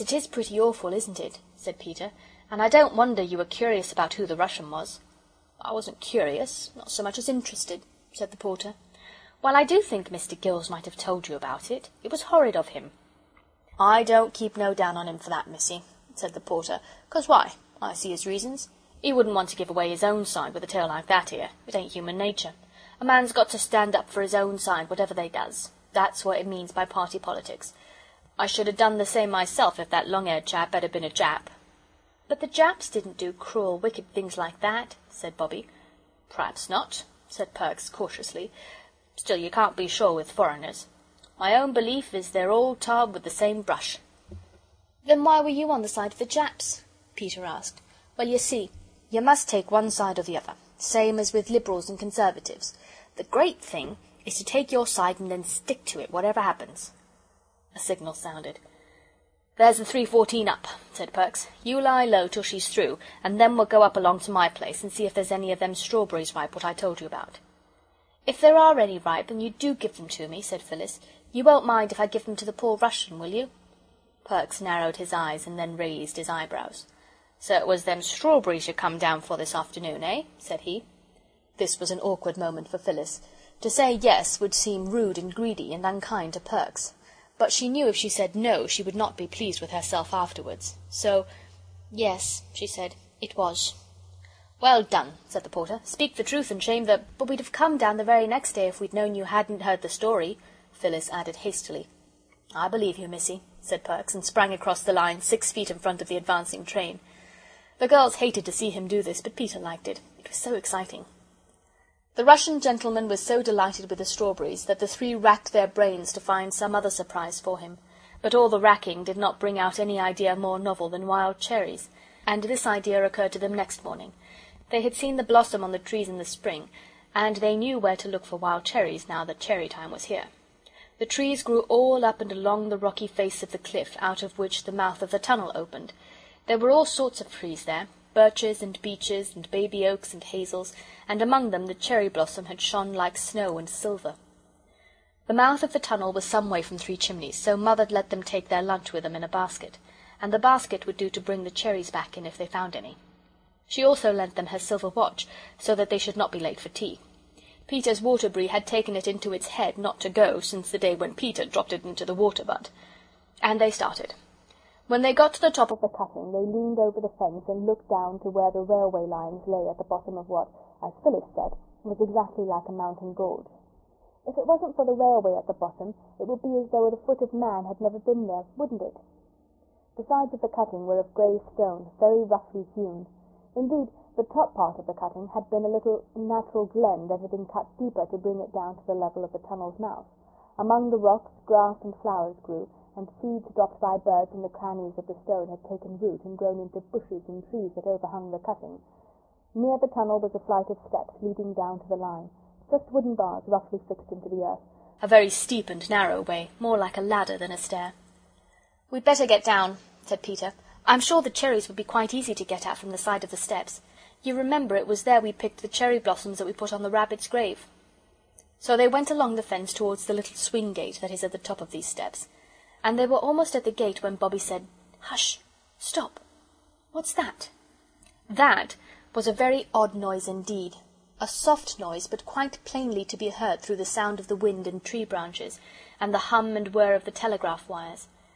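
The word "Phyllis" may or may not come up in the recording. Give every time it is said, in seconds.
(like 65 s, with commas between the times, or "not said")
70 s, 82 s, 100 s, 170 s.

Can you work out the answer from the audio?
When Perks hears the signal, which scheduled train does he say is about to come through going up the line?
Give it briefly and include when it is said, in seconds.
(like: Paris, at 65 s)
3.14, at 59 s.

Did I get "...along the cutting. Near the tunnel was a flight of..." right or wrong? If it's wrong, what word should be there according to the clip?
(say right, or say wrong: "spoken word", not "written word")
wrong: "overhung", not "along".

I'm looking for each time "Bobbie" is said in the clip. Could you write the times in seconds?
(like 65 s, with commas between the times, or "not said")
35 s, 224 s.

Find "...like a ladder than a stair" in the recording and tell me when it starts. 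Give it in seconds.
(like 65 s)
206 s.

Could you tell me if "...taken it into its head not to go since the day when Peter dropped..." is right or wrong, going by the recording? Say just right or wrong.
right.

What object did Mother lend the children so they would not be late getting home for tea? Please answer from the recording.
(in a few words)
Her silver watch.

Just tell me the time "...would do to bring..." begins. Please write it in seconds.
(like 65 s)
150 s.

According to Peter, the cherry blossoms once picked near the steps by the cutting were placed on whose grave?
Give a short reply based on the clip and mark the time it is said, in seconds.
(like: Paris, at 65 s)
The rabbit's, at 216 s.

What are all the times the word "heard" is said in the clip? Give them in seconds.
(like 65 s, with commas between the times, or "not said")
99 s, 233 s.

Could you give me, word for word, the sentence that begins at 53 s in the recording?
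The great thing is to take your side and then stick to it, whatever happens.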